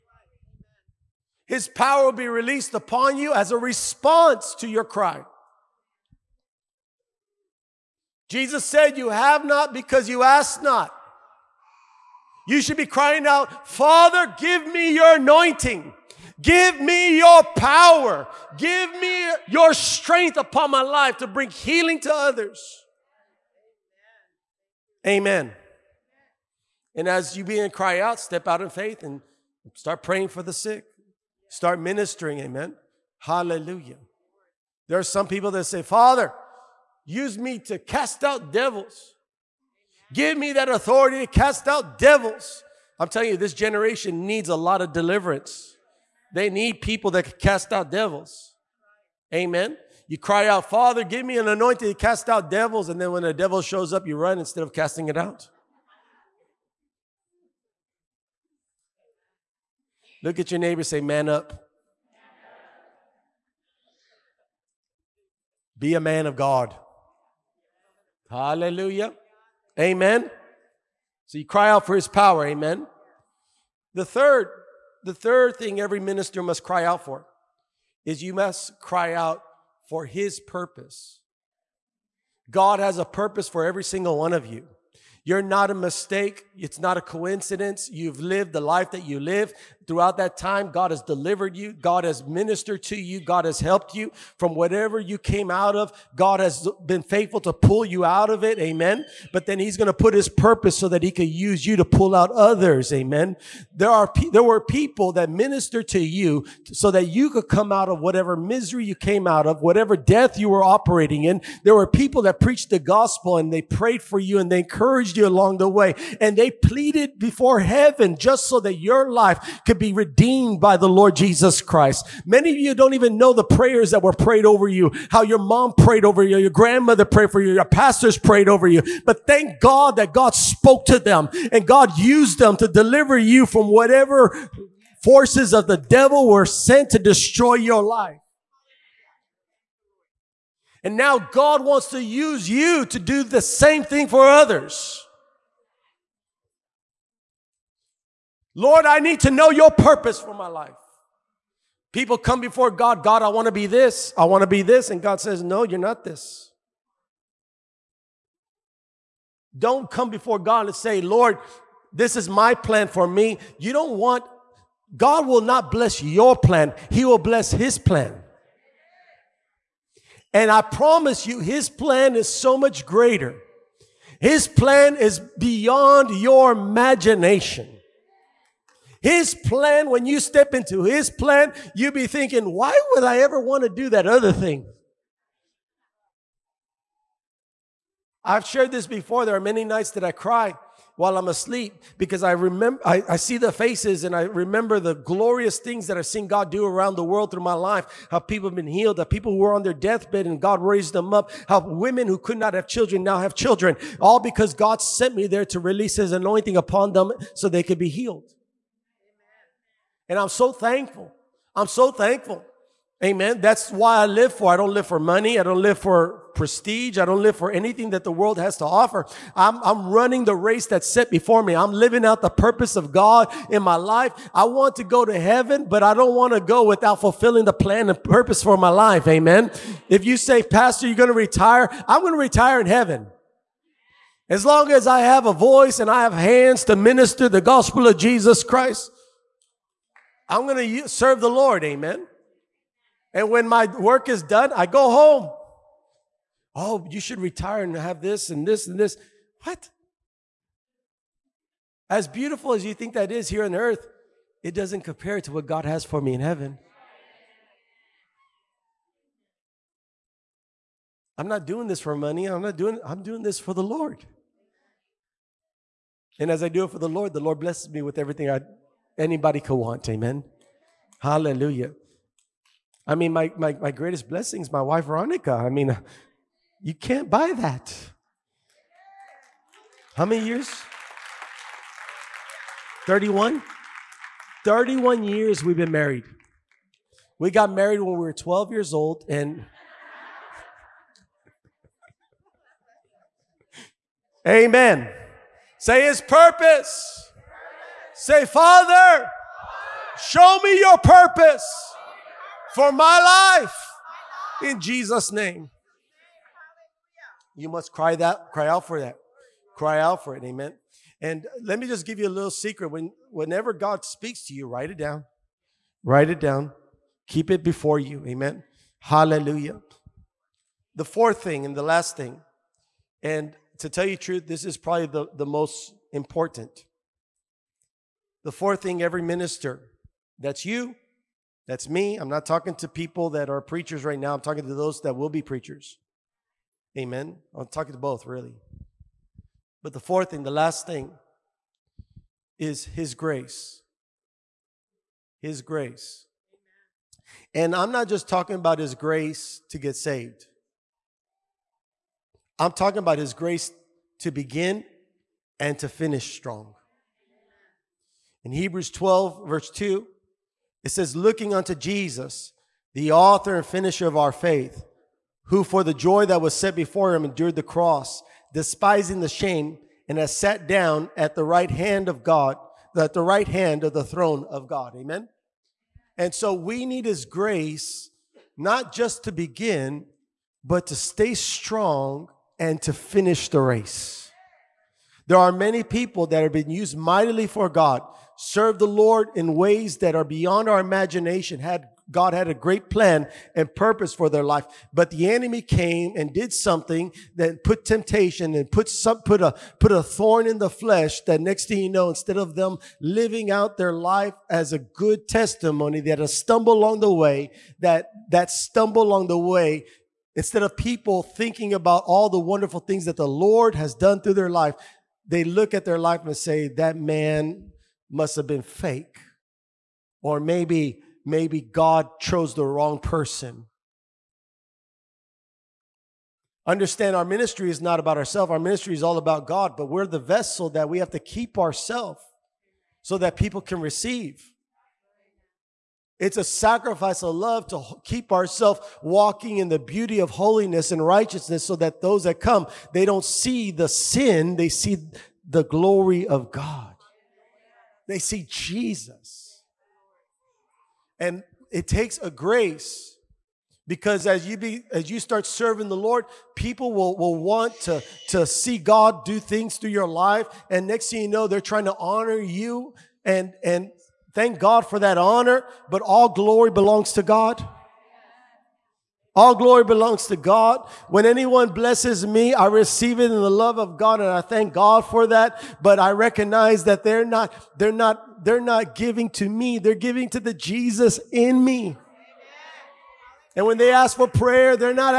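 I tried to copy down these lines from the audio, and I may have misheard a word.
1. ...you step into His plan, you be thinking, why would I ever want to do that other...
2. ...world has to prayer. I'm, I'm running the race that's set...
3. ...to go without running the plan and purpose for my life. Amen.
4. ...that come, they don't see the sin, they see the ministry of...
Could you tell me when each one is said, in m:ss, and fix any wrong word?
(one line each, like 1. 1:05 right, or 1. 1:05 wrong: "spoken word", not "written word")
1. 3:00 right
2. 3:38 wrong: "offer", not "prayer"
3. 3:46 wrong: "fulfilling", not "running"
4. 7:22 wrong: "glory", not "ministry".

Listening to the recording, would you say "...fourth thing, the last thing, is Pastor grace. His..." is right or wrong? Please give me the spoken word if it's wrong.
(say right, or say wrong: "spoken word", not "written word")
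wrong: "His", not "Pastor".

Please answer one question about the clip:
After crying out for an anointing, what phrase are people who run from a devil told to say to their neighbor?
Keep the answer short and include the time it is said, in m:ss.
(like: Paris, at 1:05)
Man up, at 1:01.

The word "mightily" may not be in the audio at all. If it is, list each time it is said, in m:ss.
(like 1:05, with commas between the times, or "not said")
6:26.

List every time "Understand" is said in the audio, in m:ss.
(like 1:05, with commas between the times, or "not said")
7:06.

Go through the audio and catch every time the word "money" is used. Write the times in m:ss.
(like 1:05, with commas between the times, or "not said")
3:34, 4:21.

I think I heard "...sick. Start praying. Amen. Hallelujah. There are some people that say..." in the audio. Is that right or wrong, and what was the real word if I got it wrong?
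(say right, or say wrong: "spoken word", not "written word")
wrong: "ministering", not "praying".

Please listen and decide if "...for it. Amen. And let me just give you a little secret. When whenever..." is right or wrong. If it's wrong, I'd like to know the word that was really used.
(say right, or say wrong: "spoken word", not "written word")
right.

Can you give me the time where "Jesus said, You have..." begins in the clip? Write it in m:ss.
0:08.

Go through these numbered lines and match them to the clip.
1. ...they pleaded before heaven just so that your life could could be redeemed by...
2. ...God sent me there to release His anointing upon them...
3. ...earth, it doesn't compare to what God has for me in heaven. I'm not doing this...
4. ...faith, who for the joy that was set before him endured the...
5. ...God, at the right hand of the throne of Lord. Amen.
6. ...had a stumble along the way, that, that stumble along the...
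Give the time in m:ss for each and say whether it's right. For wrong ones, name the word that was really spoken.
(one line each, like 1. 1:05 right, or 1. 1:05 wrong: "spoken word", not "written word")
1. 1:56 right
2. 3:24 right
3. 4:13 right
4. 6:04 right
5. 6:12 wrong: "God", not "Lord"
6. 6:45 right.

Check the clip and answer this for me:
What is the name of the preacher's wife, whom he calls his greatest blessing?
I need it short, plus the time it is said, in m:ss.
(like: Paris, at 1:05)
Veronica, at 4:34.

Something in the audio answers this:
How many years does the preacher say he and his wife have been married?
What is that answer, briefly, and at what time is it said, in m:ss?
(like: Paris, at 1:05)
31, at 4:44.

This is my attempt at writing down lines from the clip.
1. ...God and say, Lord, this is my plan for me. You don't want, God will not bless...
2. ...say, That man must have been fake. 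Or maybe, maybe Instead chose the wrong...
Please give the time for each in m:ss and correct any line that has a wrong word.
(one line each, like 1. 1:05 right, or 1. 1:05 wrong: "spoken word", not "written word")
1. 2:40 right
2. 6:56 wrong: "God", not "Instead".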